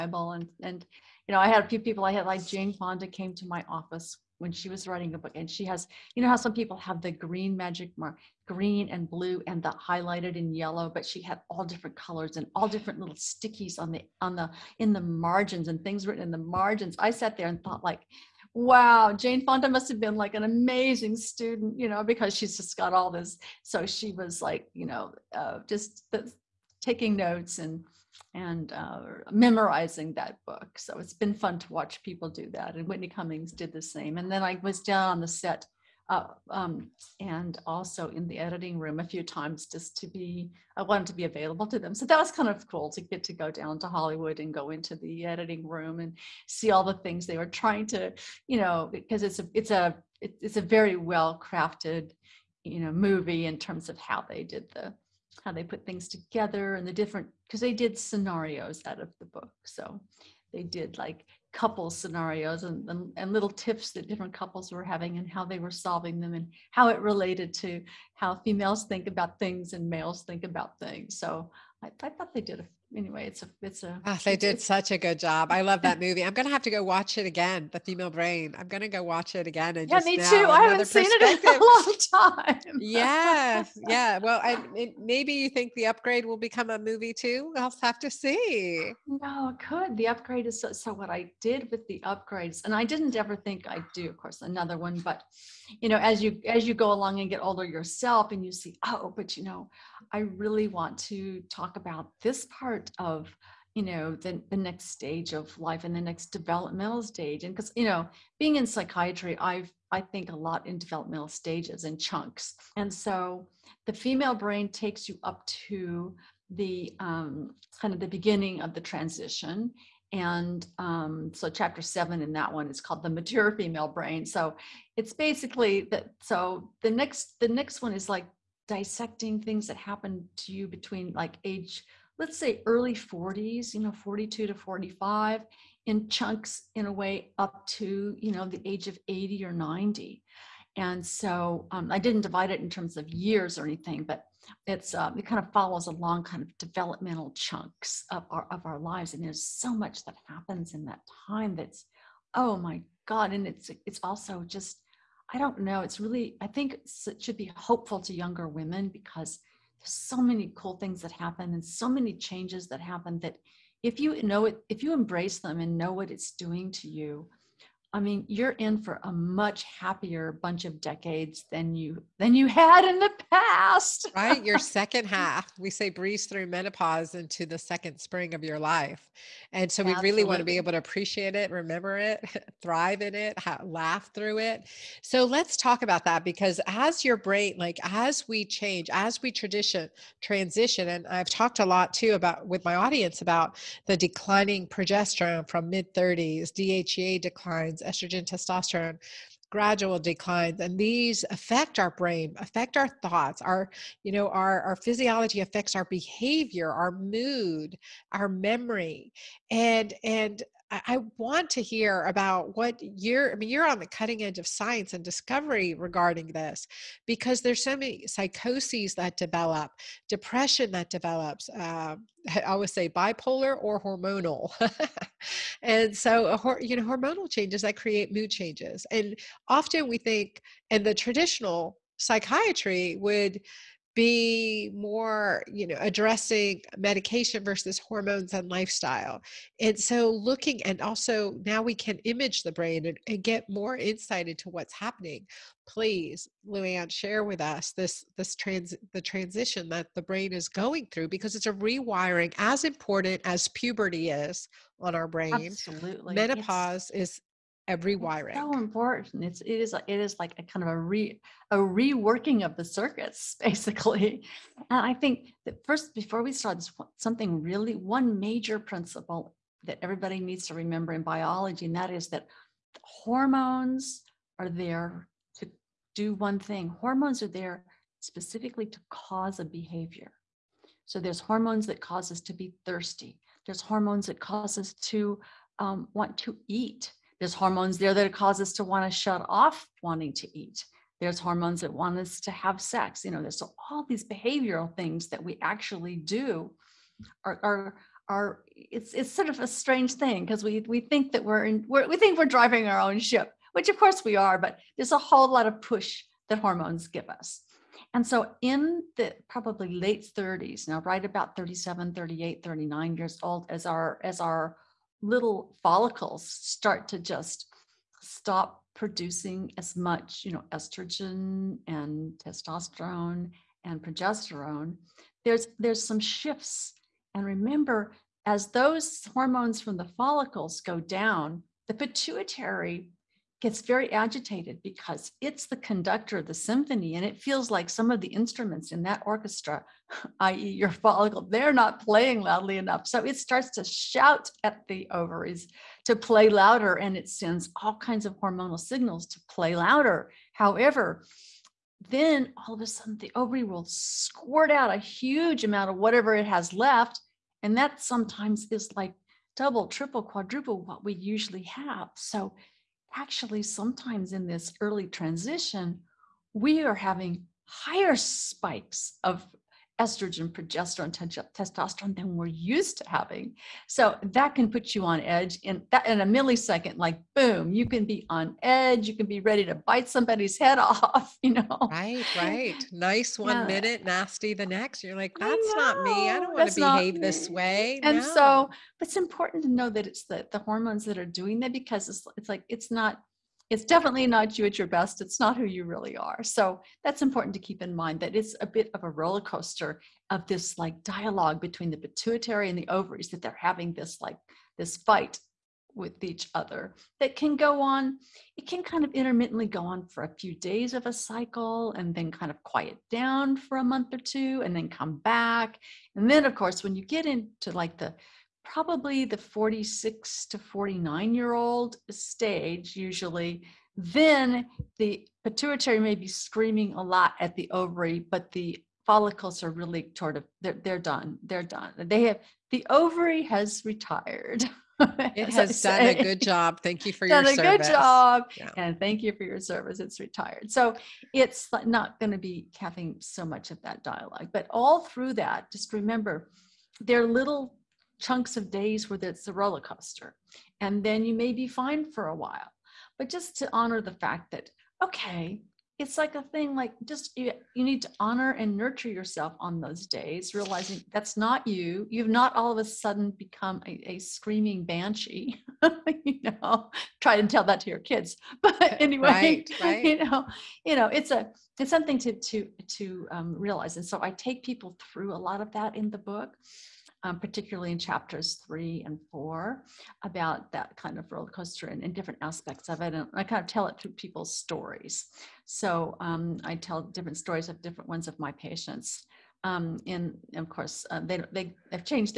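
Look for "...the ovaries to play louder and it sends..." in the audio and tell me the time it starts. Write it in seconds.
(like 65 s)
344 s.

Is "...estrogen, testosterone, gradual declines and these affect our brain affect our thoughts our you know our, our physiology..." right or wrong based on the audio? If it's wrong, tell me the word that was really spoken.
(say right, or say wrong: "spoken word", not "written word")
right.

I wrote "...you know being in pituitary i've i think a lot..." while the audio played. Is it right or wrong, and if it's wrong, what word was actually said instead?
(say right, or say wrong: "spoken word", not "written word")
wrong: "psychiatry", not "pituitary".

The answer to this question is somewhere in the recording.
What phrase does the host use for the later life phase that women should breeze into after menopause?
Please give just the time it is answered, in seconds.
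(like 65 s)
177 s.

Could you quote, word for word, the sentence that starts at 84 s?
Well, I, it, maybe you think the upgrade will become a movie too.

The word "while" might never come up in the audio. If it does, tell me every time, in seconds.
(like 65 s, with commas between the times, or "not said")
452 s.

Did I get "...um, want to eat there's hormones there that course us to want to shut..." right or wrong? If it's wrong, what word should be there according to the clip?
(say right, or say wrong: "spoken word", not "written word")
wrong: "cause", not "course".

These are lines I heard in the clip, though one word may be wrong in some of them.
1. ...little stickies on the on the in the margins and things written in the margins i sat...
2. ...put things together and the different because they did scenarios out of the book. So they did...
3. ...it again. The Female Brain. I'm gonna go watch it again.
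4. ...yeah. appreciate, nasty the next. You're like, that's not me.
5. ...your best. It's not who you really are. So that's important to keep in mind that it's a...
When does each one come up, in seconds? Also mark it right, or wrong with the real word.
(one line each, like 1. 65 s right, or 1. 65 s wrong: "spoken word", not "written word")
1. 12 s right
2. 55 s right
3. 77 s right
4. 383 s wrong: "minute", not "appreciate"
5. 394 s right.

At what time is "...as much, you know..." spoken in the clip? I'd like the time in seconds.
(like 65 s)
319 s.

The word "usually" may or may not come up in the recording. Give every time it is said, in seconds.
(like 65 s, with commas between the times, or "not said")
360 s, 422 s.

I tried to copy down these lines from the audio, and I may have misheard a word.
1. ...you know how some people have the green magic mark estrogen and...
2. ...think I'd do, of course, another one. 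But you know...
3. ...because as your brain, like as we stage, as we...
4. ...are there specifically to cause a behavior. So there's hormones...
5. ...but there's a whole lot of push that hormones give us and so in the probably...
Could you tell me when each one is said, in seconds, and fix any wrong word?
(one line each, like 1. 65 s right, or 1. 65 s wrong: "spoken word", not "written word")
1. 6 s wrong: "green", not "estrogen"
2. 93 s right
3. 186 s wrong: "change", not "stage"
4. 277 s right
5. 304 s right.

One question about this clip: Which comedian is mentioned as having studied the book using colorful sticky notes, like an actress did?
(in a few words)
Whitney Cummings.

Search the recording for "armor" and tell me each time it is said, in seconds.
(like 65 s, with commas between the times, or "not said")
not said.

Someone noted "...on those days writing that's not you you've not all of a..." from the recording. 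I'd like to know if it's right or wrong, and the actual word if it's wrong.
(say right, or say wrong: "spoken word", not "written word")
wrong: "realizing", not "writing".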